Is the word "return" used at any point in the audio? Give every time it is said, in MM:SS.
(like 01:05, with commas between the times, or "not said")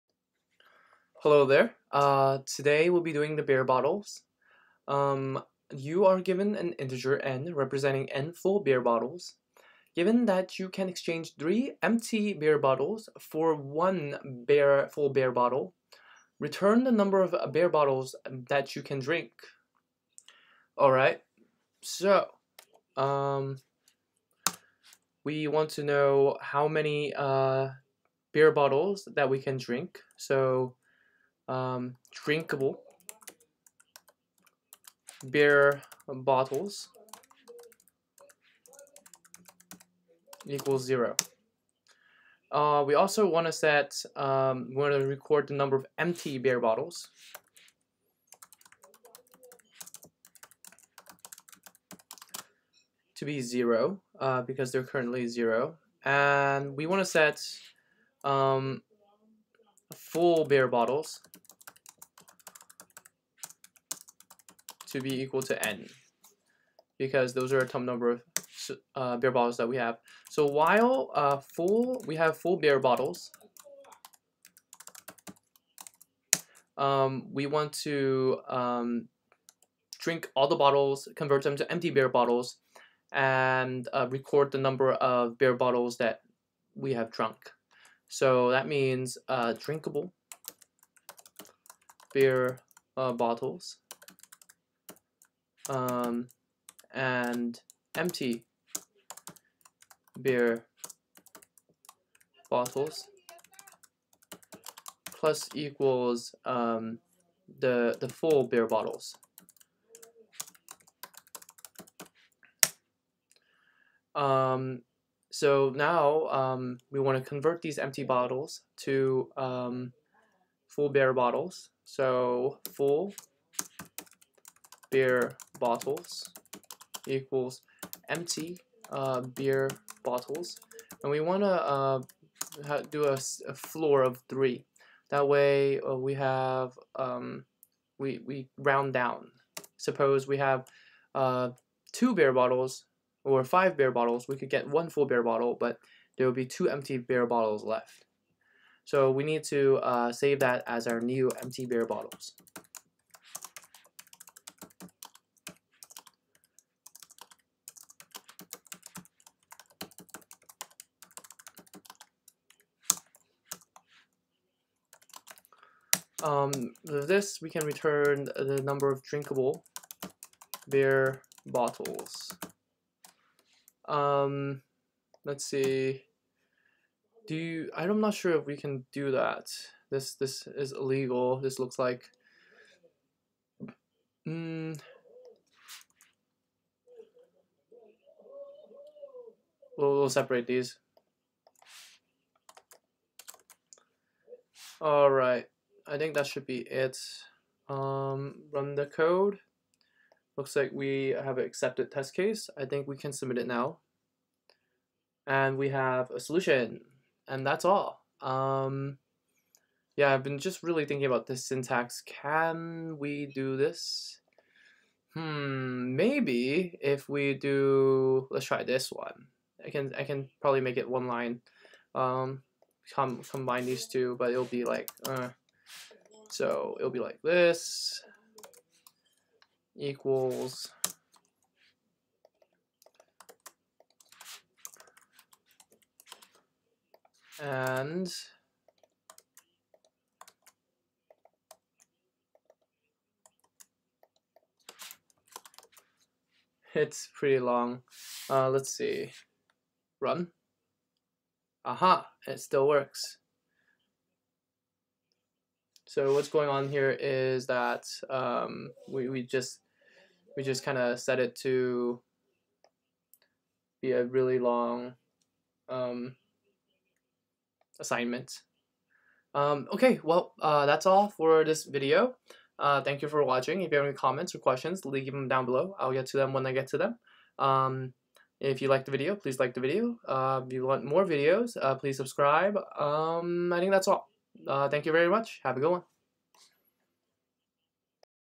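00:16, 02:47.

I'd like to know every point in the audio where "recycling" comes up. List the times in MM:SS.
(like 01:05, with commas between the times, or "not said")
not said.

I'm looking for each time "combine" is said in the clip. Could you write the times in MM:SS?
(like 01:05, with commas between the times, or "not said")
03:43.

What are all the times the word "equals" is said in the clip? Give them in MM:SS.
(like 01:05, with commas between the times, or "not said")
00:40, 01:05, 01:45, 02:07, 03:49.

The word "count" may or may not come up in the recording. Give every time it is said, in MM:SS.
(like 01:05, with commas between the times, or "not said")
not said.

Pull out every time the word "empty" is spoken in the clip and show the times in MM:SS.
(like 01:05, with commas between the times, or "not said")
00:11, 00:45, 01:21, 01:37, 01:57, 02:08, 02:26, 02:31.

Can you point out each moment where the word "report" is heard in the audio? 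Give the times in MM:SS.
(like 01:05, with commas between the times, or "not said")
not said.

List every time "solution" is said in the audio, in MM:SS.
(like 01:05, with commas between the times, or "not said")
03:26.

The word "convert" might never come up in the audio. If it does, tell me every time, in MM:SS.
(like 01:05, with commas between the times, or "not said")
01:21, 01:57.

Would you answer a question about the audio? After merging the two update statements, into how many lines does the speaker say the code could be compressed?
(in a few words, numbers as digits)
1.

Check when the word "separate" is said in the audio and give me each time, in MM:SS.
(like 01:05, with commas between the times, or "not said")
03:10.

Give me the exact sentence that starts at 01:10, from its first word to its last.
So while uh, full, we have full beer bottles.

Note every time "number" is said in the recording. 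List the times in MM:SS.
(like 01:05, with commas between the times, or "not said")
00:16, 00:45, 01:07, 01:24, 02:48.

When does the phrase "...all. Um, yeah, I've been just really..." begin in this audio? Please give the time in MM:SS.
03:27.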